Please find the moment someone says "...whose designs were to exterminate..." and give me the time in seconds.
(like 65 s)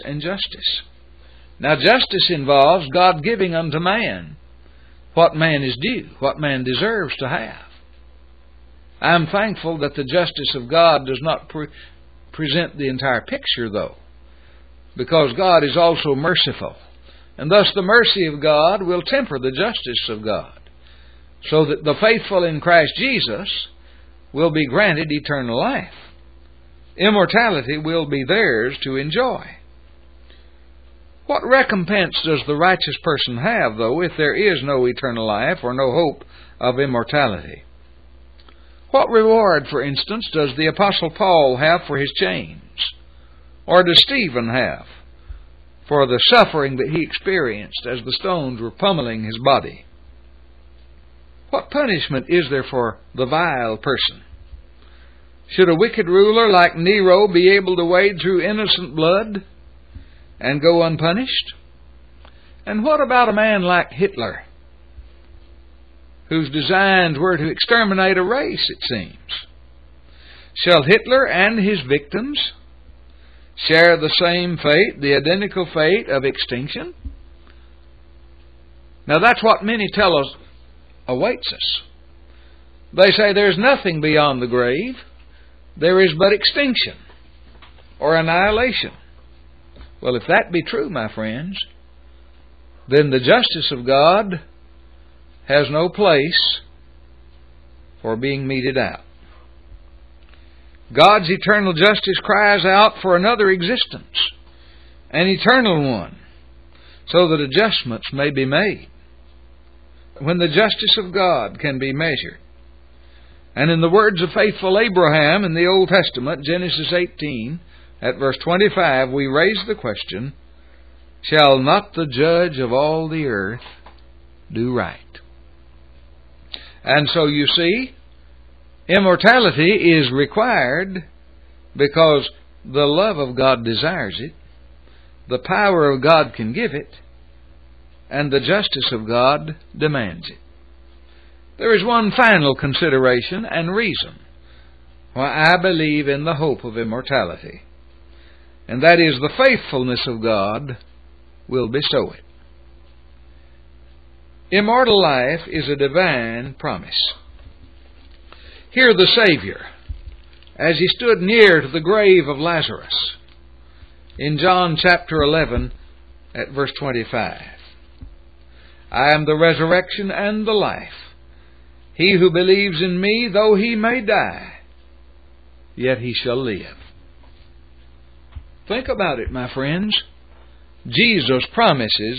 66 s.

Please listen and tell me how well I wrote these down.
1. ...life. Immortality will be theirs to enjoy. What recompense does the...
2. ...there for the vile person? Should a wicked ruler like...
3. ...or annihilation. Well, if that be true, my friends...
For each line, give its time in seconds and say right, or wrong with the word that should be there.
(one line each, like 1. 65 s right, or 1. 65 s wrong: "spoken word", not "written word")
1. 25 s right
2. 52 s right
3. 87 s right.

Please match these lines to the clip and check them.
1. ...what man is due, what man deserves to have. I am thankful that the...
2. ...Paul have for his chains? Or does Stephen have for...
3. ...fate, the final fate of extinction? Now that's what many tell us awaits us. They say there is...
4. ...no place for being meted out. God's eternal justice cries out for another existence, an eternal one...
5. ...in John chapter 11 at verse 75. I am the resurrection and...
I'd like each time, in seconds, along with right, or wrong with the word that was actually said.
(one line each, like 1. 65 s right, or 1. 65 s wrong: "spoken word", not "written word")
1. 5 s right
2. 41 s right
3. 74 s wrong: "identical", not "final"
4. 95 s right
5. 164 s wrong: "25", not "75".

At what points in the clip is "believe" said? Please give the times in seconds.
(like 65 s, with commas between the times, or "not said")
145 s, 172 s.